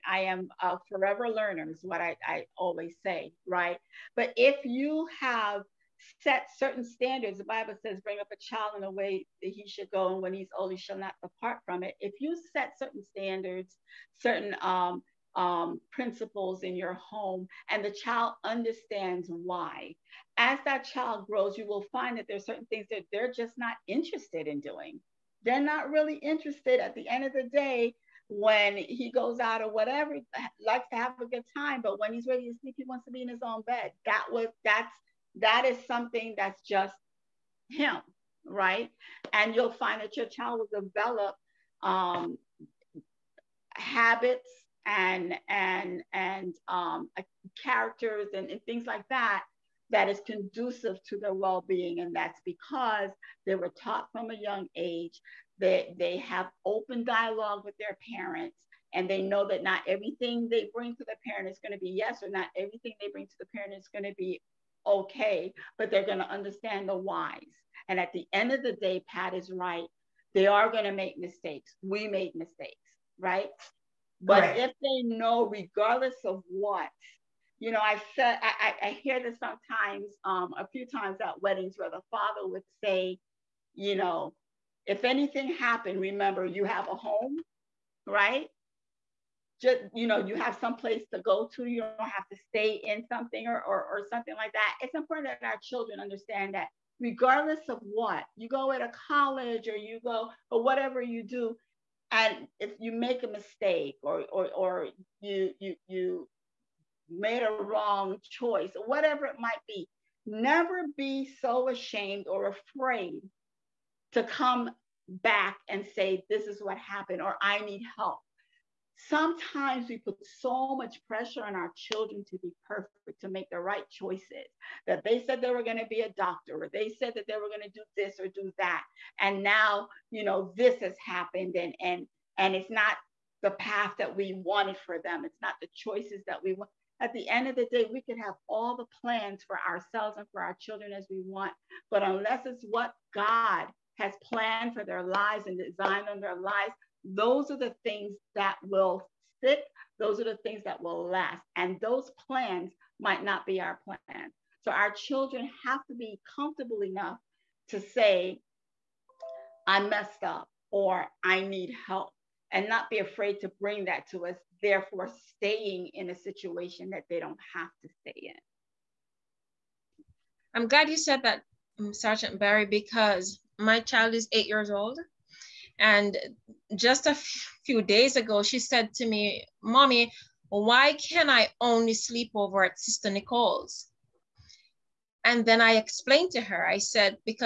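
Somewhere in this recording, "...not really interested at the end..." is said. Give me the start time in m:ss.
0:25.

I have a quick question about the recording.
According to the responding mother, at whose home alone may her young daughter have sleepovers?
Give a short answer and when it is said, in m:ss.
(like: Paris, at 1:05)
Sister Nicole's, at 3:02.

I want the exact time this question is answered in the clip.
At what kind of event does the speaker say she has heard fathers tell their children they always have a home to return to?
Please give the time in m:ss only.
1:21.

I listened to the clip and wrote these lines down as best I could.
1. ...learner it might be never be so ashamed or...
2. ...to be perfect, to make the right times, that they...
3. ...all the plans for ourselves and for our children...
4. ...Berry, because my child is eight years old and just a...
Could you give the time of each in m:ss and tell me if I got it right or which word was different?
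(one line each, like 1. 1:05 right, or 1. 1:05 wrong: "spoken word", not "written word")
1. 1:48 wrong: "whatever", not "learner"
2. 2:02 wrong: "choices", not "times"
3. 2:18 right
4. 2:52 right.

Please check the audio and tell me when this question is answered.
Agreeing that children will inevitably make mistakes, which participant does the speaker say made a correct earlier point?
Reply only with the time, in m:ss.
1:09.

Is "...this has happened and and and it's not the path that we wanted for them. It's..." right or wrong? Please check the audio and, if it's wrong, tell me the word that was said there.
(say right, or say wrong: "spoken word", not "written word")
right.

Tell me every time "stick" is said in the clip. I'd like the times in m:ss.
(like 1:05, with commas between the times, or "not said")
2:29.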